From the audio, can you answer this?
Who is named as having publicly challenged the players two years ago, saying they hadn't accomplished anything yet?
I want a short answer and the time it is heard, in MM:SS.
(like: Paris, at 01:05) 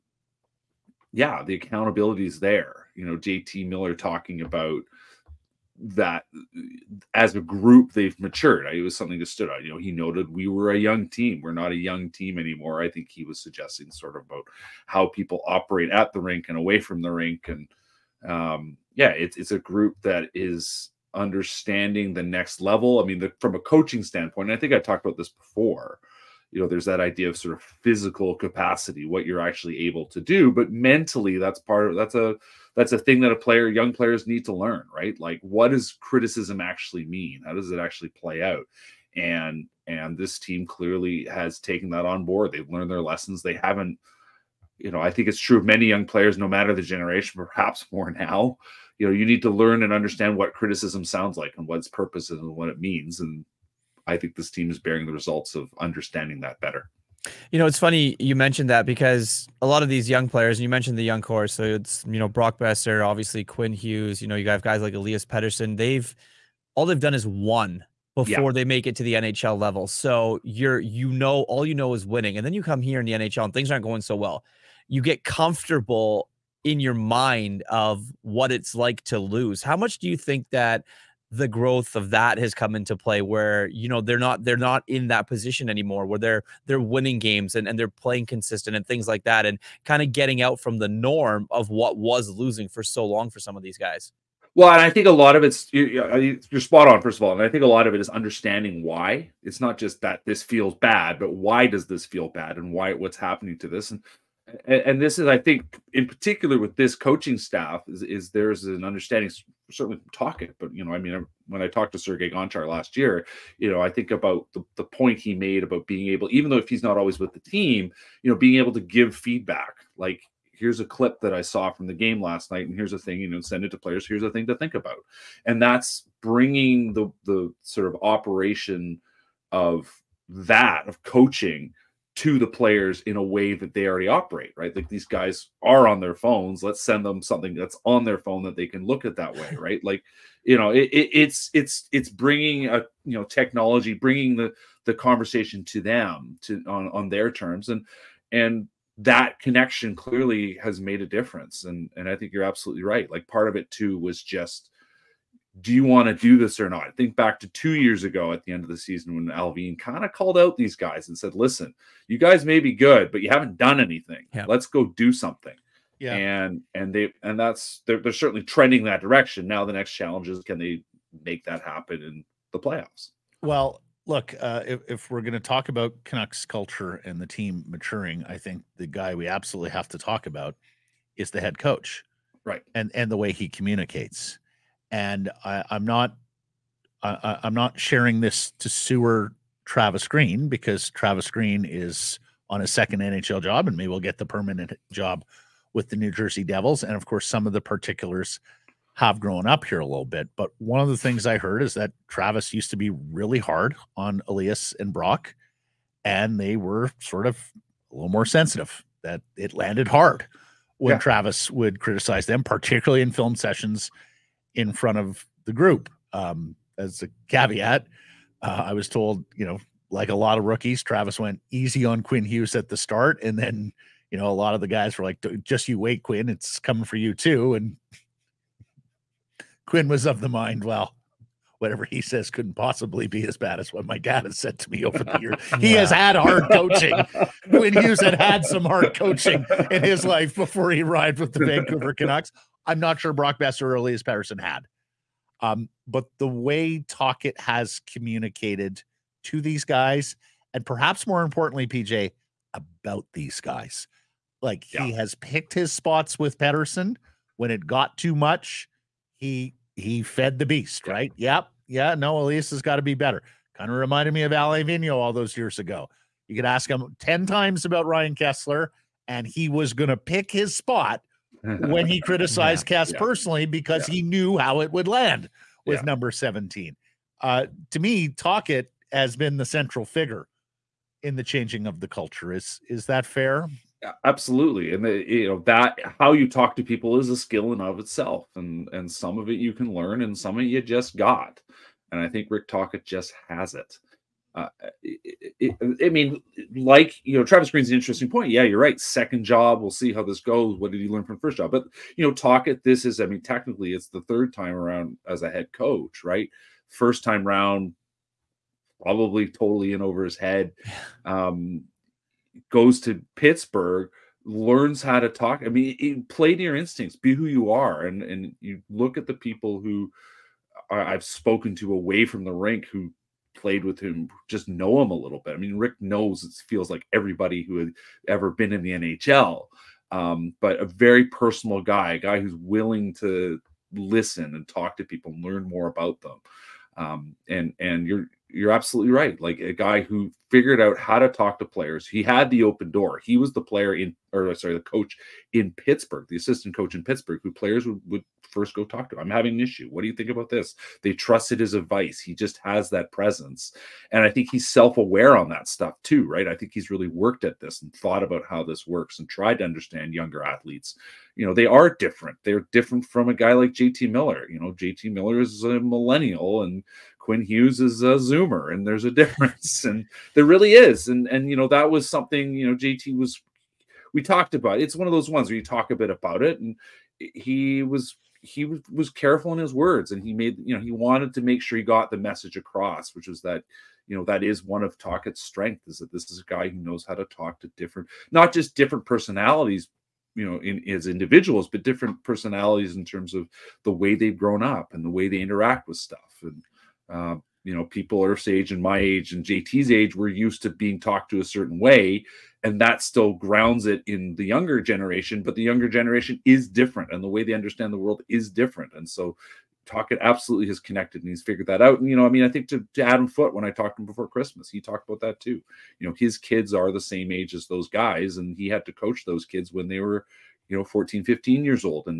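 Allvin, at 02:39.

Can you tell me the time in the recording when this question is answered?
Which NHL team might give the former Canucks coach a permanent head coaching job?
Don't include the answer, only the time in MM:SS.
03:15.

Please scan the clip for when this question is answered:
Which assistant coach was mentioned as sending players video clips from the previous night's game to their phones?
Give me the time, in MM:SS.
01:51.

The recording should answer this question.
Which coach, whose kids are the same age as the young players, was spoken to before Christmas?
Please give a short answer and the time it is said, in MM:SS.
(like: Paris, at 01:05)
Adam Foote, at 06:52.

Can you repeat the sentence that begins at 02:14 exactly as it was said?
Like these guys are on their phones.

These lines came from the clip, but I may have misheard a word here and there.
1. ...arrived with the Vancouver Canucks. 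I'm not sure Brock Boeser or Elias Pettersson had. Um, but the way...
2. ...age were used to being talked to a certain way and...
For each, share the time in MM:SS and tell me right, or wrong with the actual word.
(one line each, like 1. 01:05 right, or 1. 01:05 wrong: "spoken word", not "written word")
1. 04:00 right
2. 06:39 right.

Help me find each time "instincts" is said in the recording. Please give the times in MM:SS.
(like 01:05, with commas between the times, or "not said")
05:16.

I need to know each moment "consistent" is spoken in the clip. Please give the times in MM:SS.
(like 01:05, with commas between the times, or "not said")
01:28.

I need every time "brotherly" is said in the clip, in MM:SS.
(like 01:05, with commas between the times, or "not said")
not said.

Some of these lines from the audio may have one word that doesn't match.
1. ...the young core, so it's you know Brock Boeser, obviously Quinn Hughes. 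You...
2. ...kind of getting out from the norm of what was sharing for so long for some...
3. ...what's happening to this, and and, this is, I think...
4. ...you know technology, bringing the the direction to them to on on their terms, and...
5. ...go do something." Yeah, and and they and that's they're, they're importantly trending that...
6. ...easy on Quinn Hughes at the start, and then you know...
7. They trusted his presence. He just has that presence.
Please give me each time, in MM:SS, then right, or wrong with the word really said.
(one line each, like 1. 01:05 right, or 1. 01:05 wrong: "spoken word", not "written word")
1. 01:00 right
2. 01:29 wrong: "losing", not "sharing"
3. 01:42 right
4. 02:23 wrong: "conversation", not "direction"
5. 02:44 wrong: "certainly", not "importantly"
6. 03:41 right
7. 05:50 wrong: "advice", not "presence".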